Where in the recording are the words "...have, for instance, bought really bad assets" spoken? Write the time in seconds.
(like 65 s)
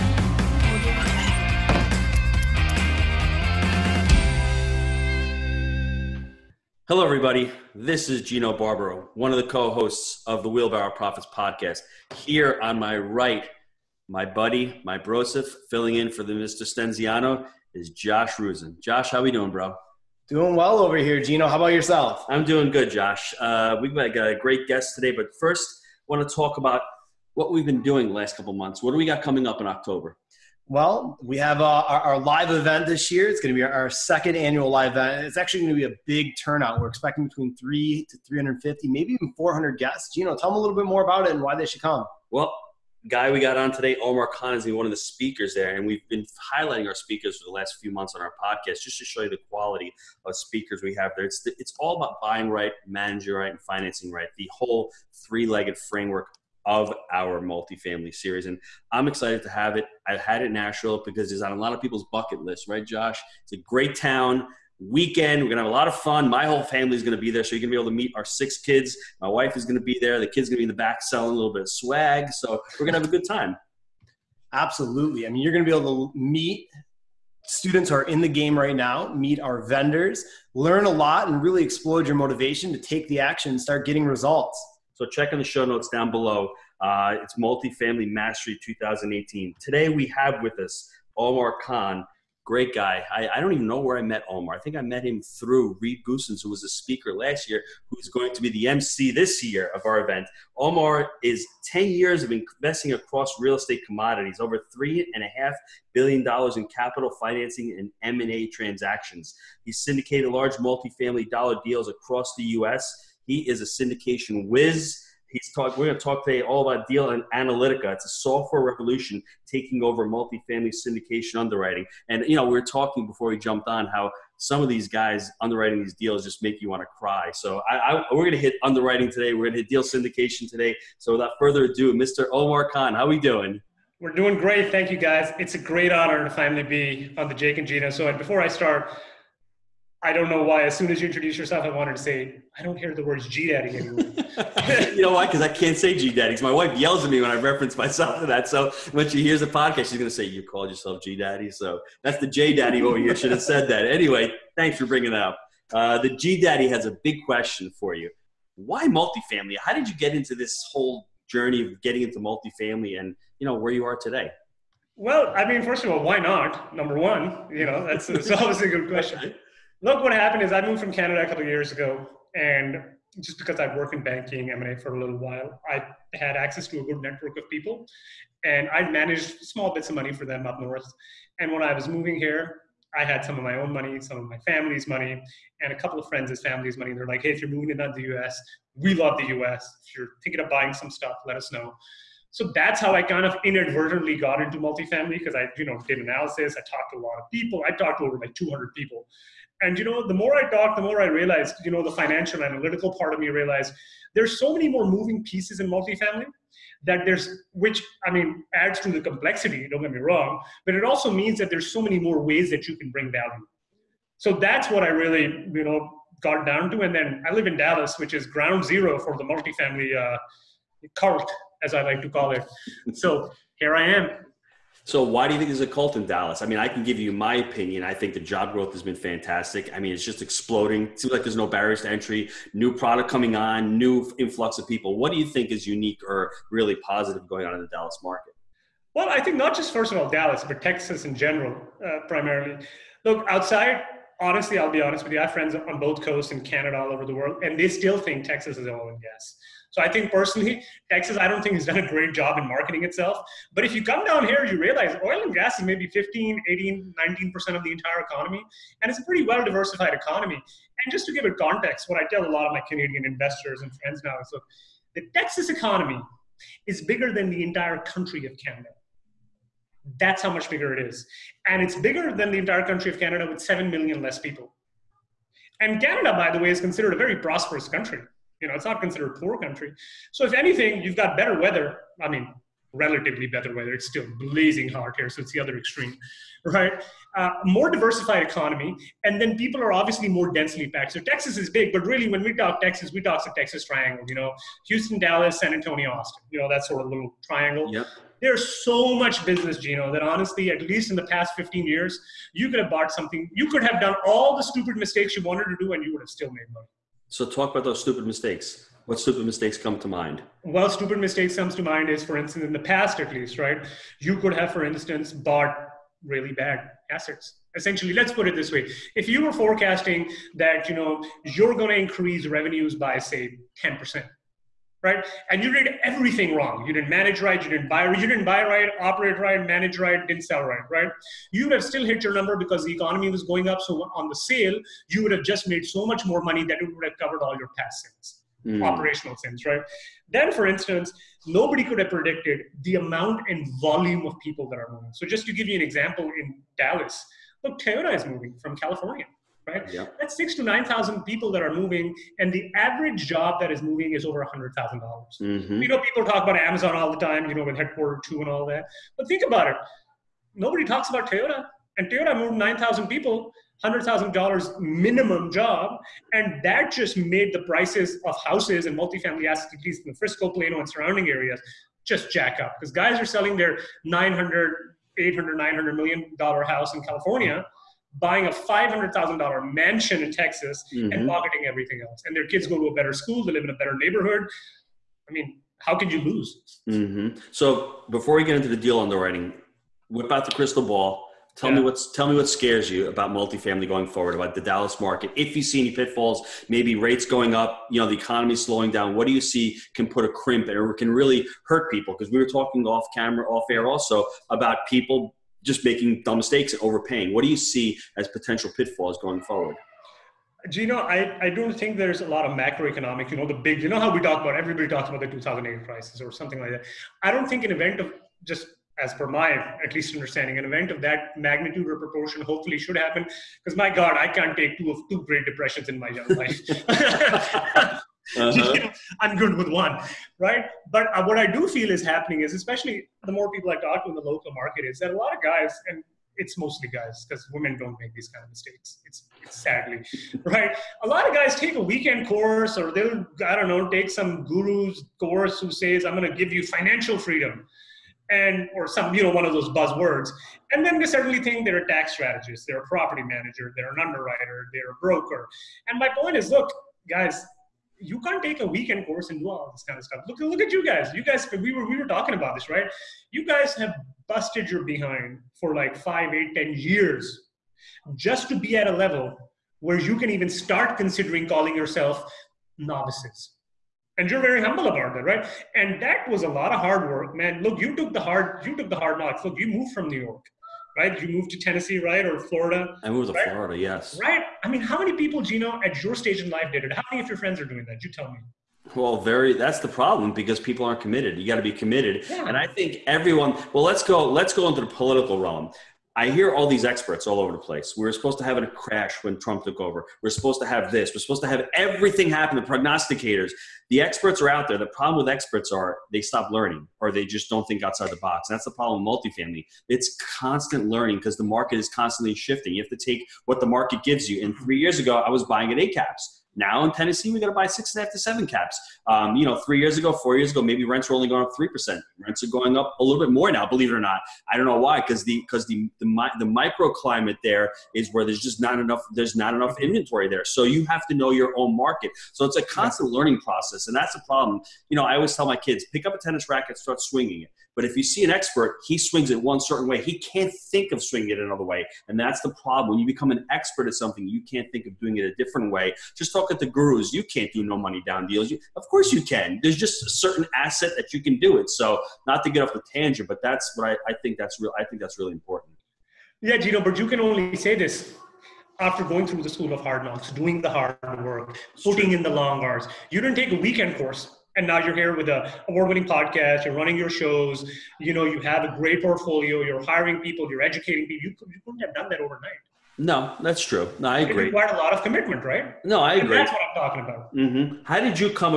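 314 s.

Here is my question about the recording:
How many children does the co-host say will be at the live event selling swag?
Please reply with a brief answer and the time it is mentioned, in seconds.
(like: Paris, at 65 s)
6, at 68 s.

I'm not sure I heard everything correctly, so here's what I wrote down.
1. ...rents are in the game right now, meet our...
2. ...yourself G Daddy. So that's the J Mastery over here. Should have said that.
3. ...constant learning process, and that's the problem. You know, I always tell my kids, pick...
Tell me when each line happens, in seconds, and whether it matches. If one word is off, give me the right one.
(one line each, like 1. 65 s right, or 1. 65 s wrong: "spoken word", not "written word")
1. 77 s wrong: "students", not "rents"
2. 150 s wrong: "Daddy", not "Mastery"
3. 532 s right.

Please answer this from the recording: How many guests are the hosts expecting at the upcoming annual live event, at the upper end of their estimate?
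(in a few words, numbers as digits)
400.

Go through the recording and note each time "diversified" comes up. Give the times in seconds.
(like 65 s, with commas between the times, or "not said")
259 s, 287 s.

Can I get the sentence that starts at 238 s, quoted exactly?
Well, I think not just first of all Dallas, but Texas in general, uh, primarily.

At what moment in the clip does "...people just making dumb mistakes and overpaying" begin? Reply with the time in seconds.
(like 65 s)
404 s.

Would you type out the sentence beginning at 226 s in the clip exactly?
I mean, I can give you my opinion.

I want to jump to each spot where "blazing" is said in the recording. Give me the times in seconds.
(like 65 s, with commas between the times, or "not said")
284 s.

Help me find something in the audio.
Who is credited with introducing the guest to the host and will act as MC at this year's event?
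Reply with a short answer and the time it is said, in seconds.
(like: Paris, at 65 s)
Reed Goossens, at 95 s.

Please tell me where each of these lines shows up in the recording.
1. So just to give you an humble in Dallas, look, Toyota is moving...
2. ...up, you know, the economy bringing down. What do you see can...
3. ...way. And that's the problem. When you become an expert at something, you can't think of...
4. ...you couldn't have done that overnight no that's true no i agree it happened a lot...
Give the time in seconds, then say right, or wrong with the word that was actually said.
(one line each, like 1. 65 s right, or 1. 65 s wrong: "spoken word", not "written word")
1. 344 s wrong: "example", not "humble"
2. 397 s wrong: "slowing", not "bringing"
3. 541 s right
4. 571 s wrong: "required", not "happened".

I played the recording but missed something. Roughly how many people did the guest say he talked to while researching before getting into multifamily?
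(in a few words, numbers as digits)
200.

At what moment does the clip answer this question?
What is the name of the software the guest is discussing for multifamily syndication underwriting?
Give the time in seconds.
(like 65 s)
116 s.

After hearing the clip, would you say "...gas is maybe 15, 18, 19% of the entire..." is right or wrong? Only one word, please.
right.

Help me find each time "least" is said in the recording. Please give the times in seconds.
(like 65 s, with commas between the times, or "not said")
300 s, 313 s, 369 s, 419 s.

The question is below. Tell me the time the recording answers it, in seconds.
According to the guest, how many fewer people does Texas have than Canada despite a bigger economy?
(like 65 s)
273 s.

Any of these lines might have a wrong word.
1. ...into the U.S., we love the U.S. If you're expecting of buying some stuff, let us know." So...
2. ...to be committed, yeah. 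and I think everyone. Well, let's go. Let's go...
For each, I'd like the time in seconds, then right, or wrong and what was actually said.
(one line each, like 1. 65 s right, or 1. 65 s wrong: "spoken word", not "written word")
1. 187 s wrong: "thinking", not "expecting"
2. 491 s right.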